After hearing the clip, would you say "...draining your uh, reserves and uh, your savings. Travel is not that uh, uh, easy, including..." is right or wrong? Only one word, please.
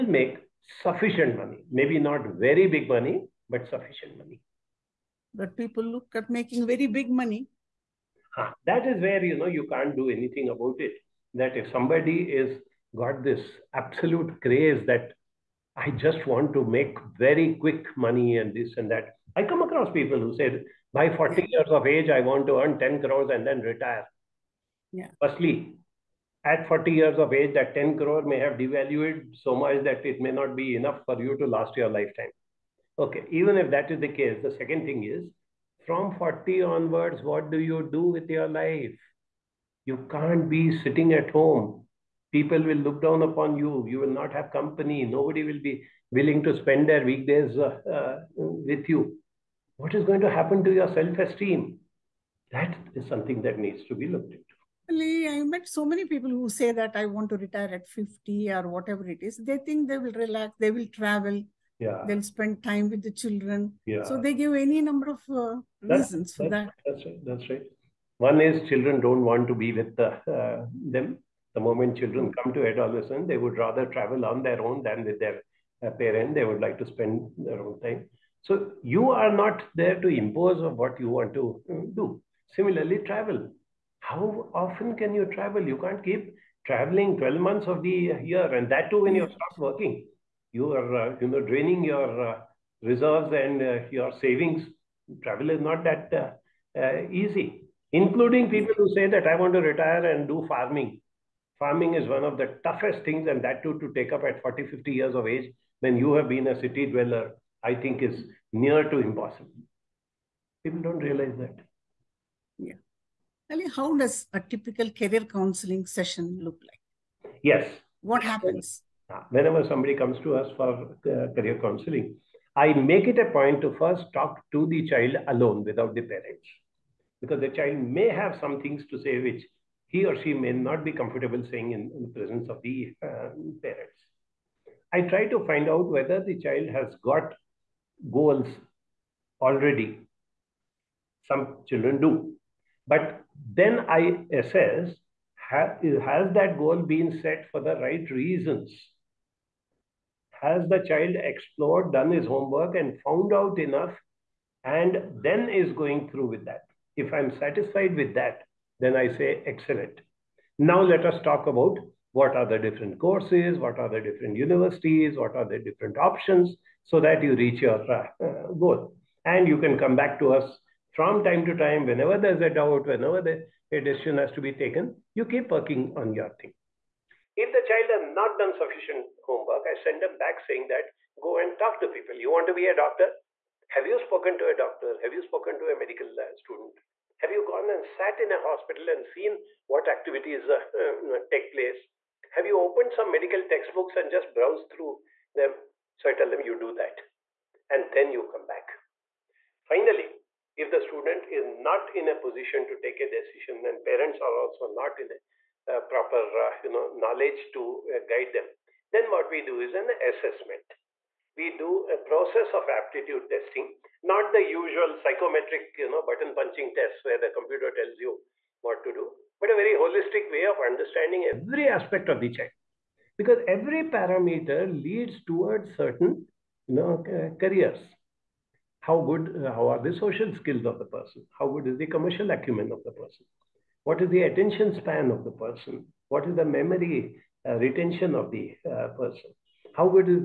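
right.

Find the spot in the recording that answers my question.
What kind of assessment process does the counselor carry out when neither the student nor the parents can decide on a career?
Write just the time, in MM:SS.
03:32.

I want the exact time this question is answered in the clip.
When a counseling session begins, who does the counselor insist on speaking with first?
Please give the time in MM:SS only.
02:04.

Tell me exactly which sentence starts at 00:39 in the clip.
You can't be sitting at home.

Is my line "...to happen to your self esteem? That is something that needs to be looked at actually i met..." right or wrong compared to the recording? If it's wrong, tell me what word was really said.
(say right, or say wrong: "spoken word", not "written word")
right.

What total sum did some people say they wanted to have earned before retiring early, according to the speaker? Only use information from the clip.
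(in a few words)
10 crores.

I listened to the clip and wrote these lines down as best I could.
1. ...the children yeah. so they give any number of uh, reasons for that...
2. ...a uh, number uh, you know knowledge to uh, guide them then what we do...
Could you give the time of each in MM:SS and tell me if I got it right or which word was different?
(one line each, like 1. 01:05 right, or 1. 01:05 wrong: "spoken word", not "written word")
1. 01:03 right
2. 03:25 wrong: "proper", not "number".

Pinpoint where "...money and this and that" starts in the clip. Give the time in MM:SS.
00:17.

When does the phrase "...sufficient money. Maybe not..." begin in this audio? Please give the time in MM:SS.
00:00.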